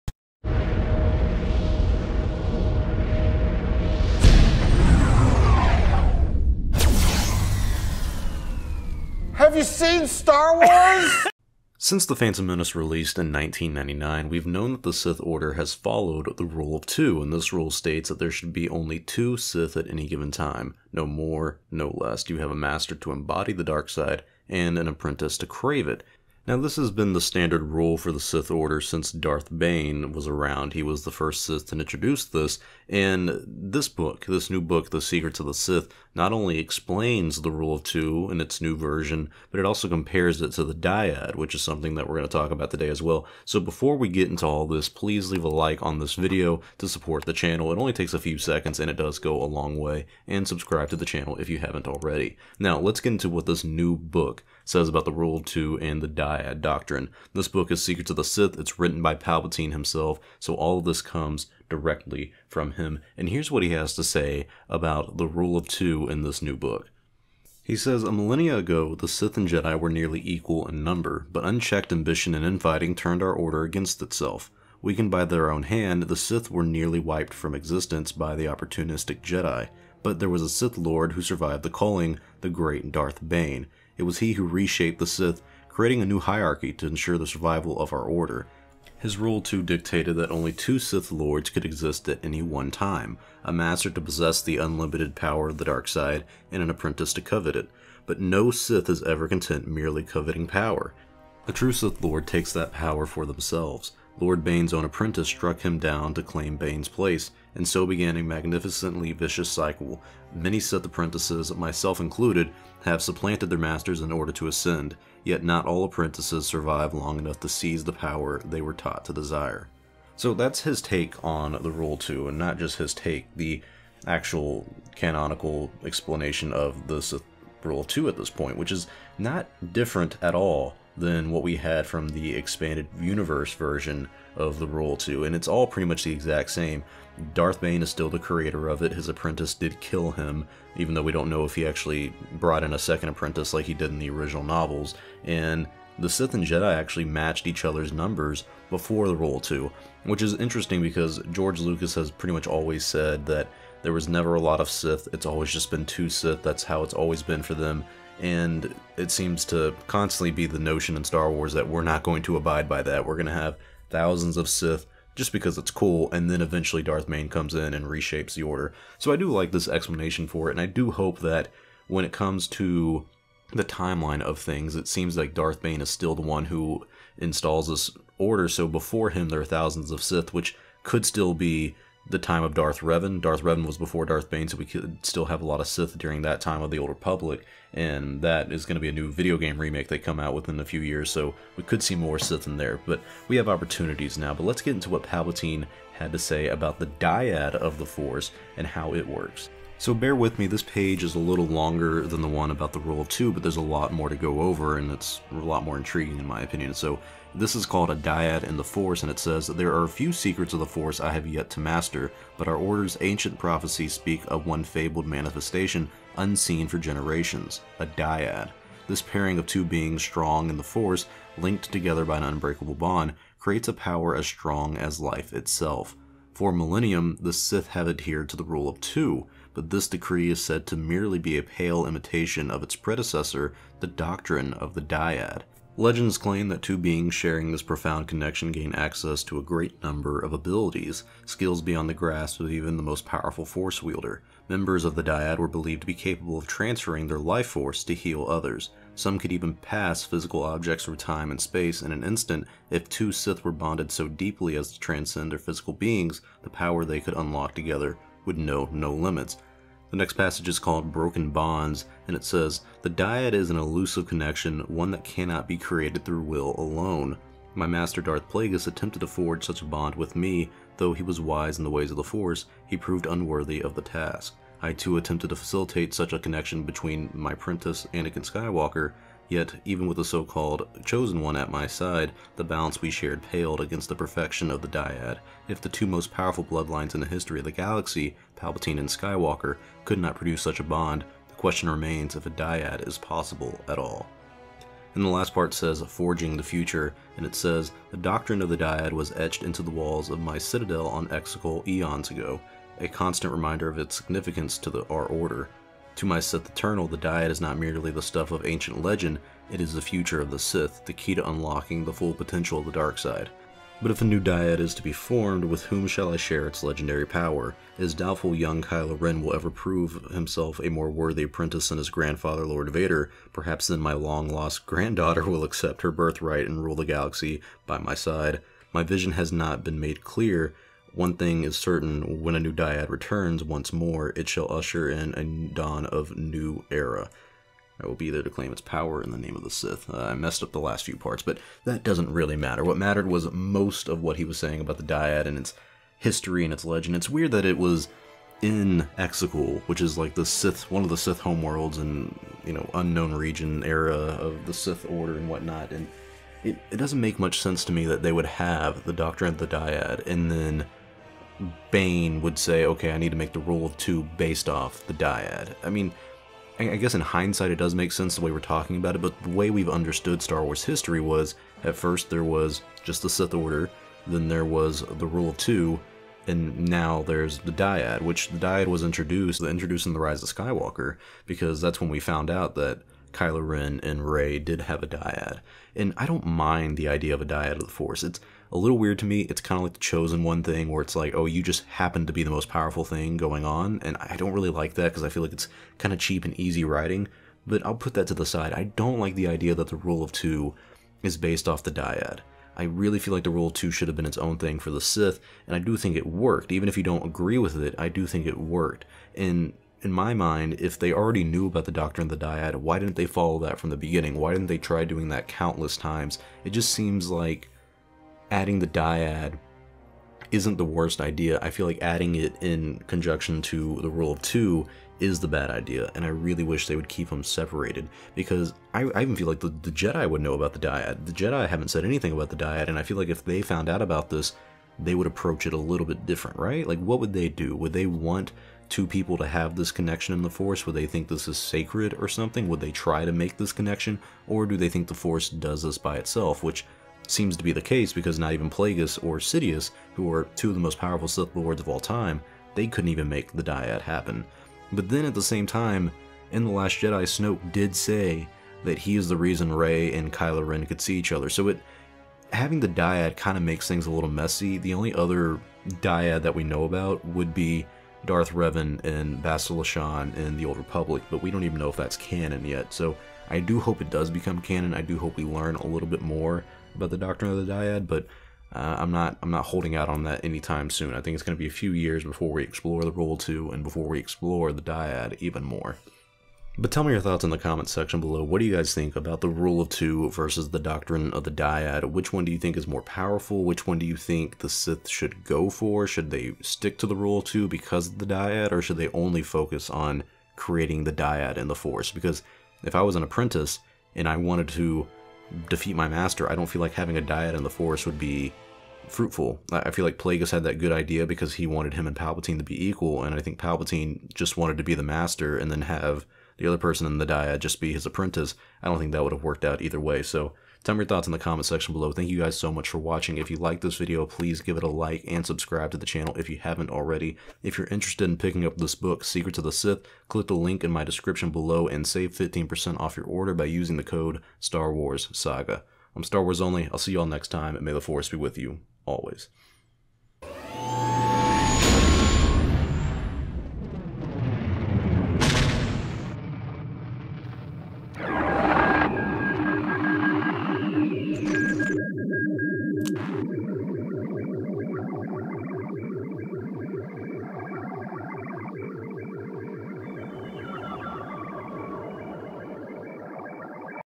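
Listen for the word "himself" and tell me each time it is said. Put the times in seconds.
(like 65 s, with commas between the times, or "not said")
59 s, 320 s.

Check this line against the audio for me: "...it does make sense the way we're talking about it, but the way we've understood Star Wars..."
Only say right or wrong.
right.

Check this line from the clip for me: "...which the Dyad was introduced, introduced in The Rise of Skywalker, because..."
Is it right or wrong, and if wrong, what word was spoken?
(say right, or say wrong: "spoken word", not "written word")
right.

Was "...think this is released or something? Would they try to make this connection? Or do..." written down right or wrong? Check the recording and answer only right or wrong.
wrong.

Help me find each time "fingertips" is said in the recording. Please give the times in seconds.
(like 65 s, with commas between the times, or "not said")
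not said.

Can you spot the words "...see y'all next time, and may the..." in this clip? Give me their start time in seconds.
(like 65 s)
536 s.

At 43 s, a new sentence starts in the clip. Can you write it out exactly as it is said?
So before we get into all this, please leave a like on this video to support the channel.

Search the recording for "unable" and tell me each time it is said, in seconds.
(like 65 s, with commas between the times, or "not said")
not said.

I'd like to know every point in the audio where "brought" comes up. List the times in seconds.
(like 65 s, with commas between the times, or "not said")
142 s.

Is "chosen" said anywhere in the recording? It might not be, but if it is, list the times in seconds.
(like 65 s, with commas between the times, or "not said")
280 s, 389 s.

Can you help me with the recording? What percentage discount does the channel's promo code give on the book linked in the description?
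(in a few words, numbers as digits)
15%.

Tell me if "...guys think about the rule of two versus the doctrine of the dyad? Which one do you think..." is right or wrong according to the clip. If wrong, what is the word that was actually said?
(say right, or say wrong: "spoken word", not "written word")
right.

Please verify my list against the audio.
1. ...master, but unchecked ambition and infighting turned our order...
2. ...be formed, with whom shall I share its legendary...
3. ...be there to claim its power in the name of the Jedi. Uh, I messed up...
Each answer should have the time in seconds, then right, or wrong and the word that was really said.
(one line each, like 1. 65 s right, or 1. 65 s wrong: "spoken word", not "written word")
1. 70 s wrong: "number", not "master"
2. 314 s right
3. 337 s wrong: "Sith", not "Jedi".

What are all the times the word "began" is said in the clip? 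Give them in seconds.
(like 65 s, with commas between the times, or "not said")
107 s.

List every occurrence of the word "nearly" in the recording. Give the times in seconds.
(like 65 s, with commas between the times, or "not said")
69 s, 76 s.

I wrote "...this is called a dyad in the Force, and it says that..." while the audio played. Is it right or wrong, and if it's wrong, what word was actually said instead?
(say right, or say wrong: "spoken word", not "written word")
right.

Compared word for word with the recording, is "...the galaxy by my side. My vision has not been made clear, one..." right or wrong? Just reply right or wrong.
right.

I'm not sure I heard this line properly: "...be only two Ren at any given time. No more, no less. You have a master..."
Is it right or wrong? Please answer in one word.
wrong.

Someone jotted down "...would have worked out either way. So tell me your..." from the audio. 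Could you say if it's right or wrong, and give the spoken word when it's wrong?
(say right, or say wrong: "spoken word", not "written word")
right.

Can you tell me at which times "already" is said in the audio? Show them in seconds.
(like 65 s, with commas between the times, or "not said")
51 s, 410 s, 526 s.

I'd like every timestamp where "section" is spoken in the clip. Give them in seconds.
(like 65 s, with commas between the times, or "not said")
487 s, 521 s.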